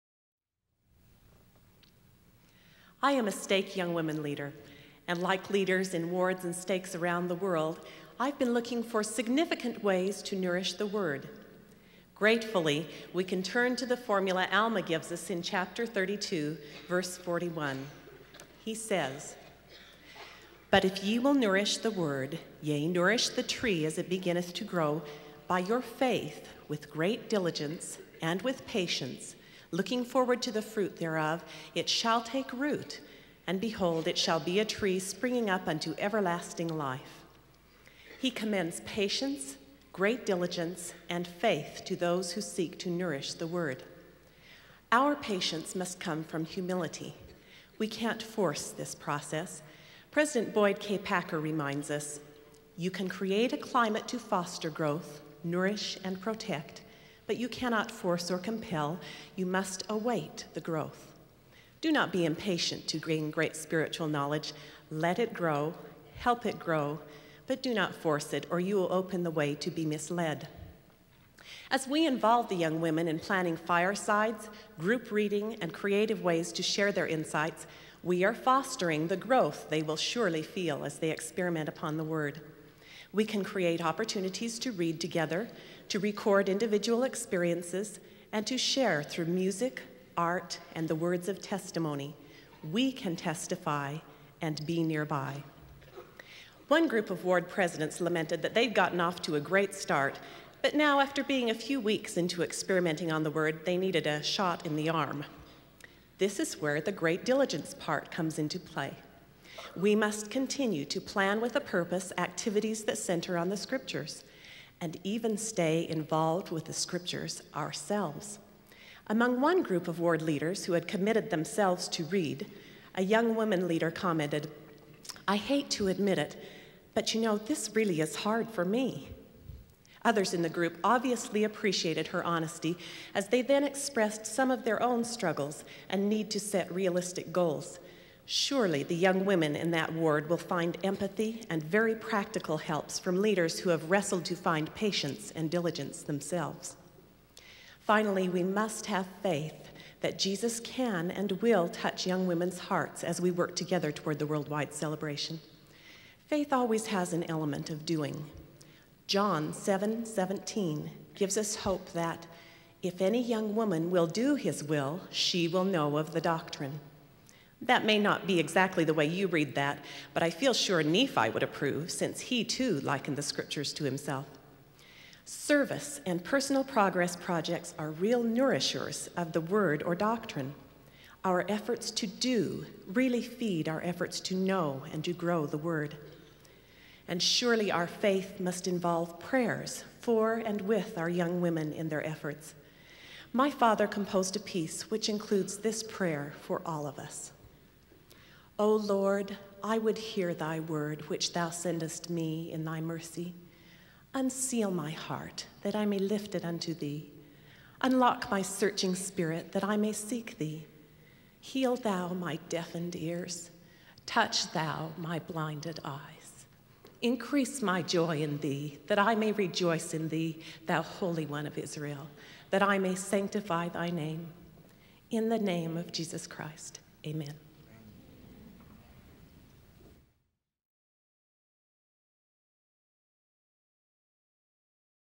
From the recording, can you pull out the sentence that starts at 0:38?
He commends patience, great diligence, and faith to those who seek to nourish the word.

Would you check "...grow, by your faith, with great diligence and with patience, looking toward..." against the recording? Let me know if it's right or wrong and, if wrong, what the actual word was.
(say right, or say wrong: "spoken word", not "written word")
wrong: "forward", not "toward".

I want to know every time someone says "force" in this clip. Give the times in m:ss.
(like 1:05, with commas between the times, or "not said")
0:48, 0:57, 1:07.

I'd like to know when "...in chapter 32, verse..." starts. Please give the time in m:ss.
0:15.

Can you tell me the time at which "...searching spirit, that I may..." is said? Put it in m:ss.
3:28.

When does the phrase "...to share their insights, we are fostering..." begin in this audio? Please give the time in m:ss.
1:16.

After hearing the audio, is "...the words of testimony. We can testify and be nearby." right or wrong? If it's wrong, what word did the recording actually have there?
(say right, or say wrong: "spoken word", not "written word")
right.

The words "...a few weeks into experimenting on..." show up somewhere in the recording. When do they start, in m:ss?
1:41.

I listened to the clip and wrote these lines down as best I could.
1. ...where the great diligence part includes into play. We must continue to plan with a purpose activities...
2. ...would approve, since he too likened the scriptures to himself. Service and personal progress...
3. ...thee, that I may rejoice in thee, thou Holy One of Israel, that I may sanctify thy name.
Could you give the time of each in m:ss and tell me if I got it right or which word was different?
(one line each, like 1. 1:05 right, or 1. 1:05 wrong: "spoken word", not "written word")
1. 1:46 wrong: "comes", not "includes"
2. 2:51 right
3. 3:38 right.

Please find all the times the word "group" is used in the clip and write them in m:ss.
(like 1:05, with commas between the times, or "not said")
1:14, 1:36, 1:59, 2:10.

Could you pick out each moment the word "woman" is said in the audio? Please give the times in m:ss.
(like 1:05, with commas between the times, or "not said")
2:03, 2:43.